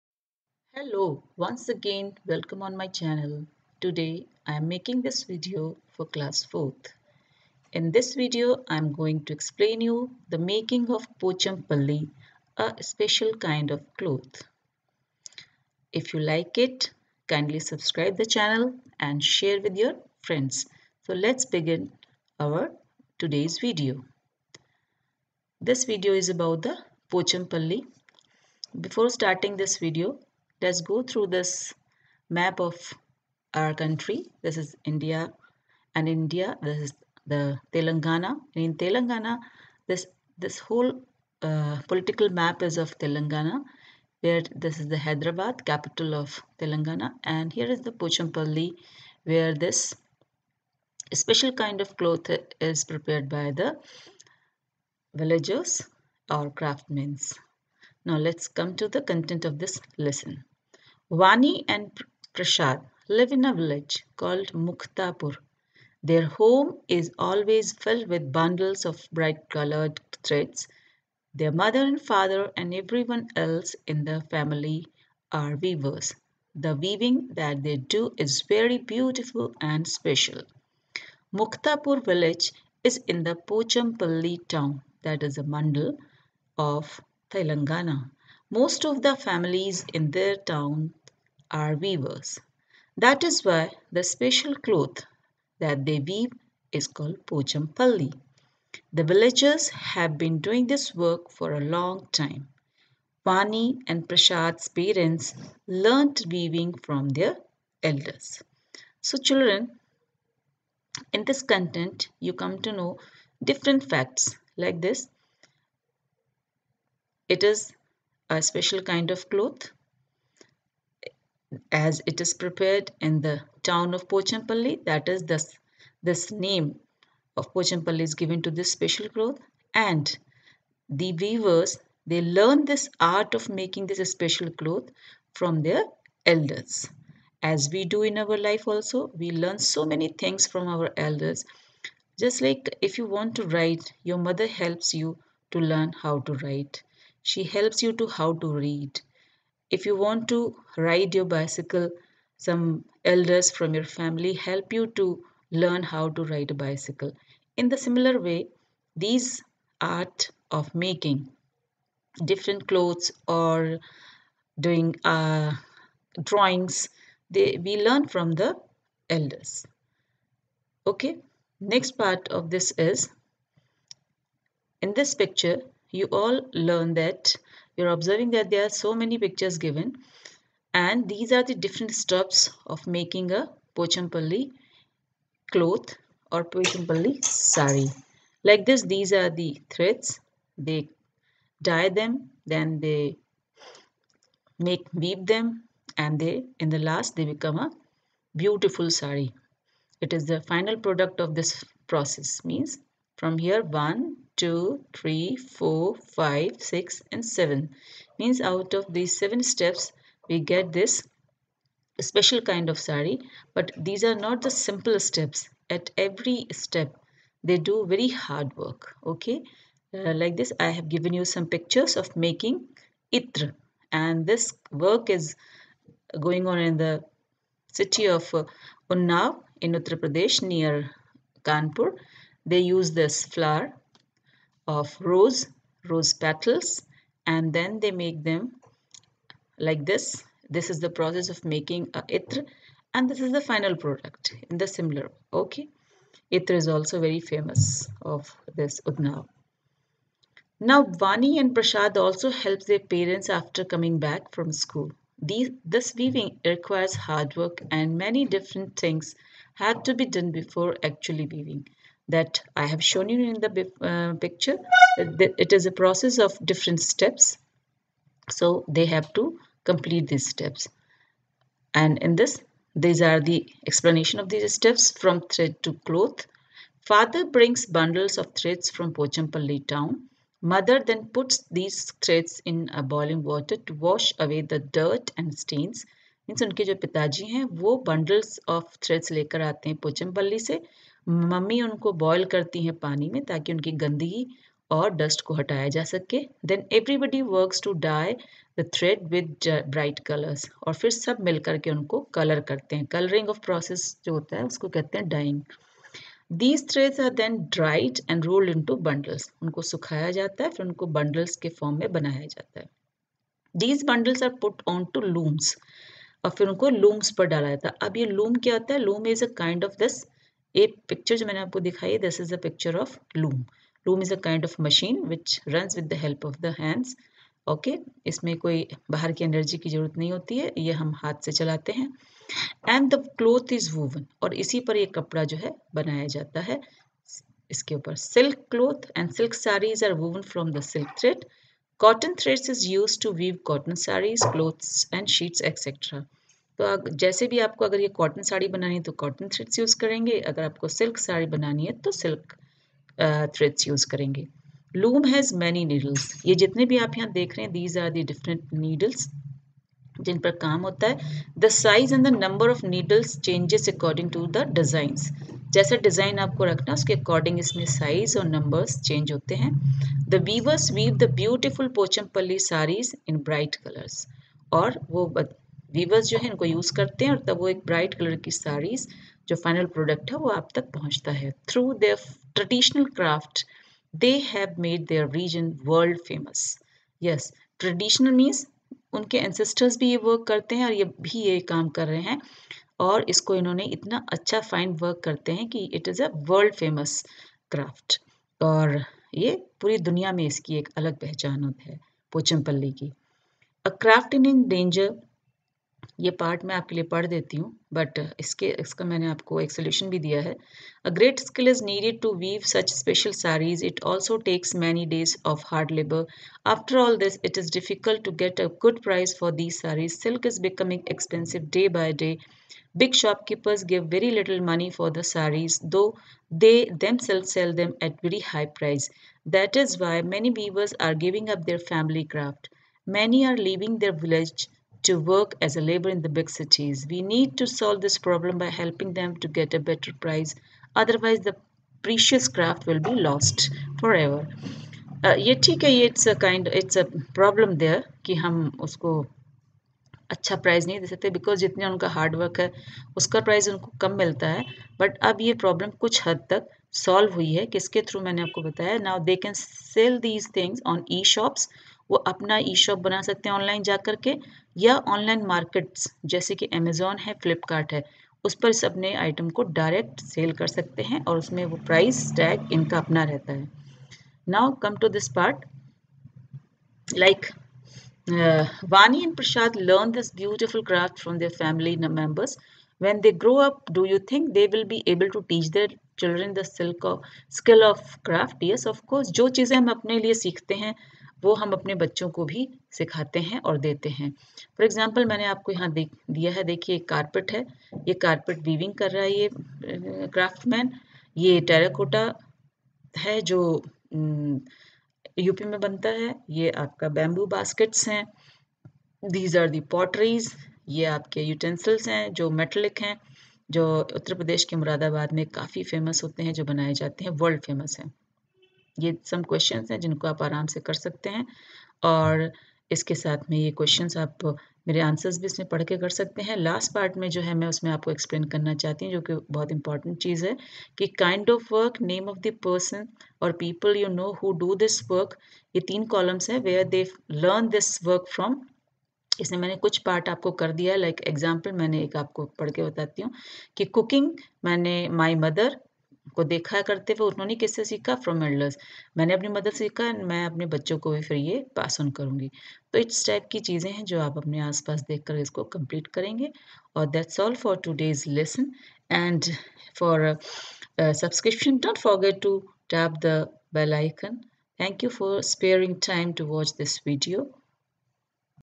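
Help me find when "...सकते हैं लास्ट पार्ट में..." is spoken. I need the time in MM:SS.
08:45.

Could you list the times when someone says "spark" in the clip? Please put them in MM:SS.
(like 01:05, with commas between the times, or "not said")
not said.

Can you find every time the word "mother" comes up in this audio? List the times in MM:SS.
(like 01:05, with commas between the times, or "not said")
01:11, 02:24, 04:40.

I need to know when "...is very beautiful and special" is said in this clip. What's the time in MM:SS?
01:18.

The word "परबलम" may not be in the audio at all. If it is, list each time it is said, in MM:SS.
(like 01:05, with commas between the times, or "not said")
07:27, 07:35.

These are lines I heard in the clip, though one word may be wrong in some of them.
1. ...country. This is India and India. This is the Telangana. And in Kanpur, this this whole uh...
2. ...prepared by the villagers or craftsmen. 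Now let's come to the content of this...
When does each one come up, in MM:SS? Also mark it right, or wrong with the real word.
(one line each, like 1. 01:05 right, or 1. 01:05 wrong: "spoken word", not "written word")
1. 00:33 wrong: "Telangana", not "Kanpur"
2. 00:52 right.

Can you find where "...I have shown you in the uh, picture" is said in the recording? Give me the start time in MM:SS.
04:22.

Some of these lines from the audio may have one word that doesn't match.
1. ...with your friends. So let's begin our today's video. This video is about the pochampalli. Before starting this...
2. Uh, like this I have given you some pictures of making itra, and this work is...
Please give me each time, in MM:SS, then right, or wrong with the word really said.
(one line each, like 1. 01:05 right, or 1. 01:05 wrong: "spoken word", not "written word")
1. 00:19 right
2. 03:39 right.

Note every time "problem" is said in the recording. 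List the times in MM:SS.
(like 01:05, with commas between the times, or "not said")
07:17.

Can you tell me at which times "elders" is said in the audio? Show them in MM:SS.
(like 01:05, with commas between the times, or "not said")
01:47, 02:16, 02:20, 02:33, 02:49.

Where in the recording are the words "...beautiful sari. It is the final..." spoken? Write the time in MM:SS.
03:18.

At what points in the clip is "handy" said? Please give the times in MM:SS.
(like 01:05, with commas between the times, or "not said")
not said.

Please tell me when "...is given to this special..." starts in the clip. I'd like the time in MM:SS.
02:08.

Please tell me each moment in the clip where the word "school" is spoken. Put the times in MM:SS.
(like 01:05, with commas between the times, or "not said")
04:14.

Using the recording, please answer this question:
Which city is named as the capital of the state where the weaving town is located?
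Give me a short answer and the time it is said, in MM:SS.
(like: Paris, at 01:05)
Hyderabad, at 00:44.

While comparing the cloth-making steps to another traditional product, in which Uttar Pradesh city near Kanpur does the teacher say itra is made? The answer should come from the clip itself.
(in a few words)
Unnav.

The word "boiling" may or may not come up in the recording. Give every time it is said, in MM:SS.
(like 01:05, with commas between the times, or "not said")
04:42.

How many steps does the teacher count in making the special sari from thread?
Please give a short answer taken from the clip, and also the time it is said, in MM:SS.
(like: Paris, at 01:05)
7, at 03:29.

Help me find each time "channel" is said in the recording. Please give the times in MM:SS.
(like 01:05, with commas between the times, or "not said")
00:02, 00:18.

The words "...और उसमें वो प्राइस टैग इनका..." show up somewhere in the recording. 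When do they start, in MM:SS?
07:51.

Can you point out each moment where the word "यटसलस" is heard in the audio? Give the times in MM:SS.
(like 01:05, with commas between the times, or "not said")
08:31.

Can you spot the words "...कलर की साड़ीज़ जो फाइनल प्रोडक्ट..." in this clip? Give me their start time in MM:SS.
06:17.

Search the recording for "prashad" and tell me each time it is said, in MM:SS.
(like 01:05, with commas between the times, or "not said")
01:02, 01:44, 04:11.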